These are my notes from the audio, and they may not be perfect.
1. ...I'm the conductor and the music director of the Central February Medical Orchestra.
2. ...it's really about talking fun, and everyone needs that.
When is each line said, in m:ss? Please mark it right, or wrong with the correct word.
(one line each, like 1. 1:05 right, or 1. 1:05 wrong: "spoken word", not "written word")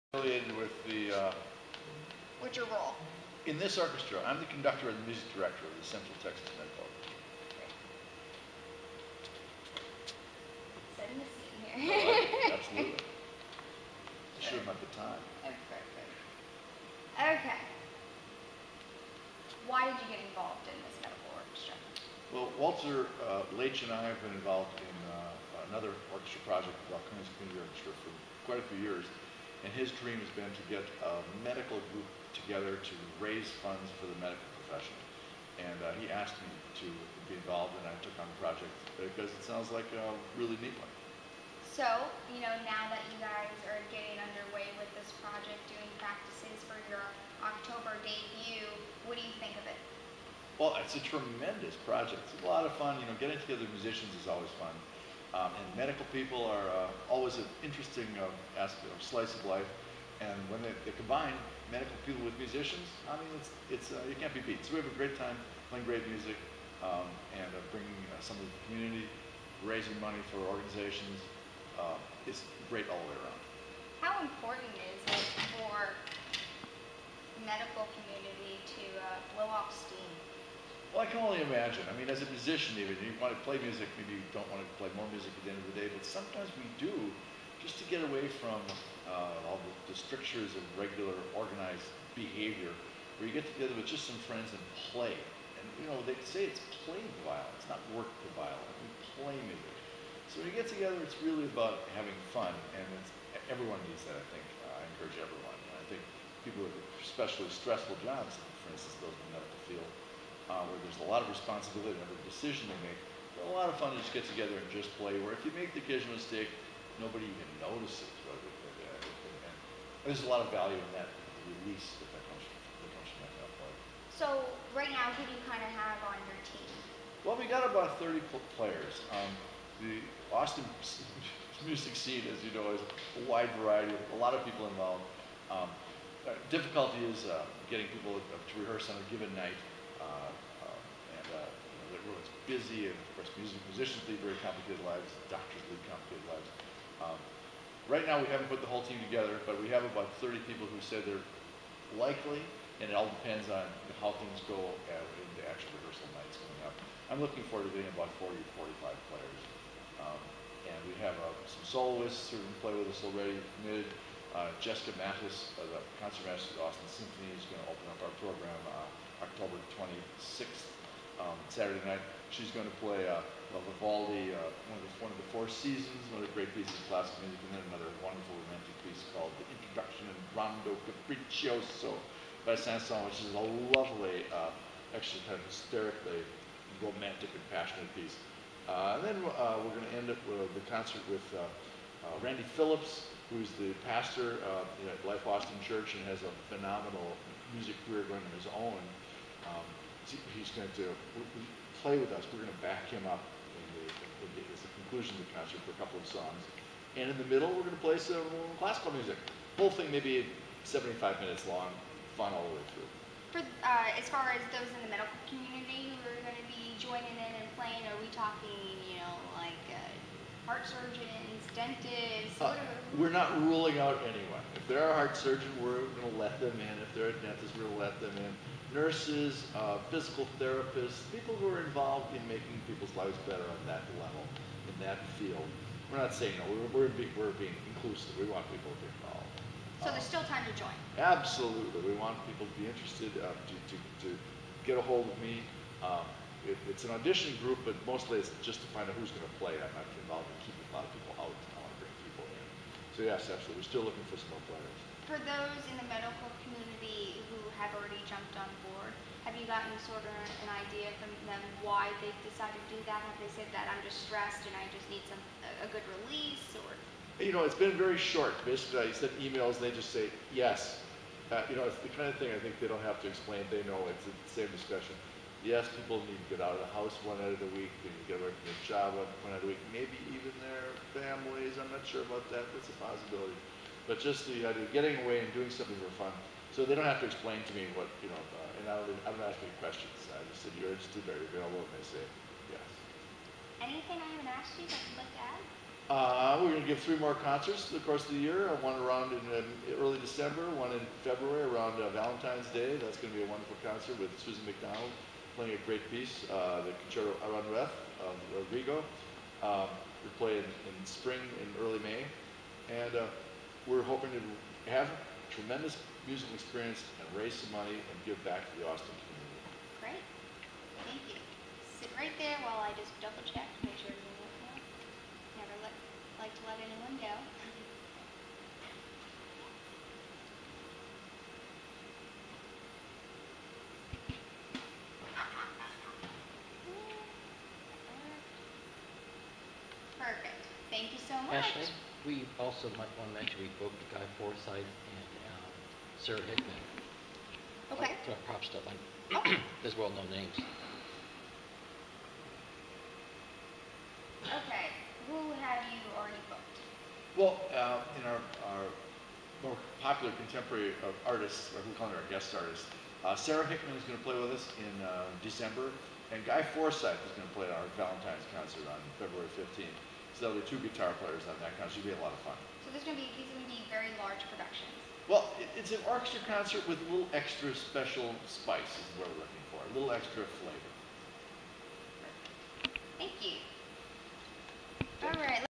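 1. 0:04 wrong: "Texas", not "February"
2. 1:41 wrong: "having", not "talking".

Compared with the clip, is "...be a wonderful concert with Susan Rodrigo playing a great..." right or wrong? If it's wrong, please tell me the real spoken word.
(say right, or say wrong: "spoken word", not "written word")
wrong: "McDonald", not "Rodrigo".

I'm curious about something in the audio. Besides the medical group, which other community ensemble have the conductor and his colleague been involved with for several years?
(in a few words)
Balcones Community Orchestra.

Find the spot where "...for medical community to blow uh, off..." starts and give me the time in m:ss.
1:15.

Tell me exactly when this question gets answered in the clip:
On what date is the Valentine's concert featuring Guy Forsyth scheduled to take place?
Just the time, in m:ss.
6:08.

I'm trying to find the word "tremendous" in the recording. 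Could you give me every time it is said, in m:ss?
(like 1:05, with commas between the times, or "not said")
0:51, 5:15.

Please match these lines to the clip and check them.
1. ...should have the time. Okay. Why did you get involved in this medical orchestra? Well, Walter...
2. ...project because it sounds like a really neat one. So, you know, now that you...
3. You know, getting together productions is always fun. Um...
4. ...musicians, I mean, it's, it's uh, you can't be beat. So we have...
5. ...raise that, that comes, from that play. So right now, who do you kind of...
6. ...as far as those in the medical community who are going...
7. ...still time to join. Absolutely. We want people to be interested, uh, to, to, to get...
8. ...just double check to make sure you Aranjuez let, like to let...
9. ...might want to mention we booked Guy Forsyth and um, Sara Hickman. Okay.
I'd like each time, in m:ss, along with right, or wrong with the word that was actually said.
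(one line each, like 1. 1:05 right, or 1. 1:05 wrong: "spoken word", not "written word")
1. 0:14 right
2. 0:38 right
3. 0:52 wrong: "musicians", not "productions"
4. 1:02 right
5. 2:01 wrong: "release", not "raise"
6. 3:33 right
7. 4:00 right
8. 5:22 wrong: "Never", not "Aranjuez"
9. 5:42 right.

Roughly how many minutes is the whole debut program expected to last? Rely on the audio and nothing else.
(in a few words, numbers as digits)
75.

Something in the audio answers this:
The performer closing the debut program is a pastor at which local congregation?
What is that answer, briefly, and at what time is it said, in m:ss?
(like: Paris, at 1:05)
Life Austin Church, at 3:15.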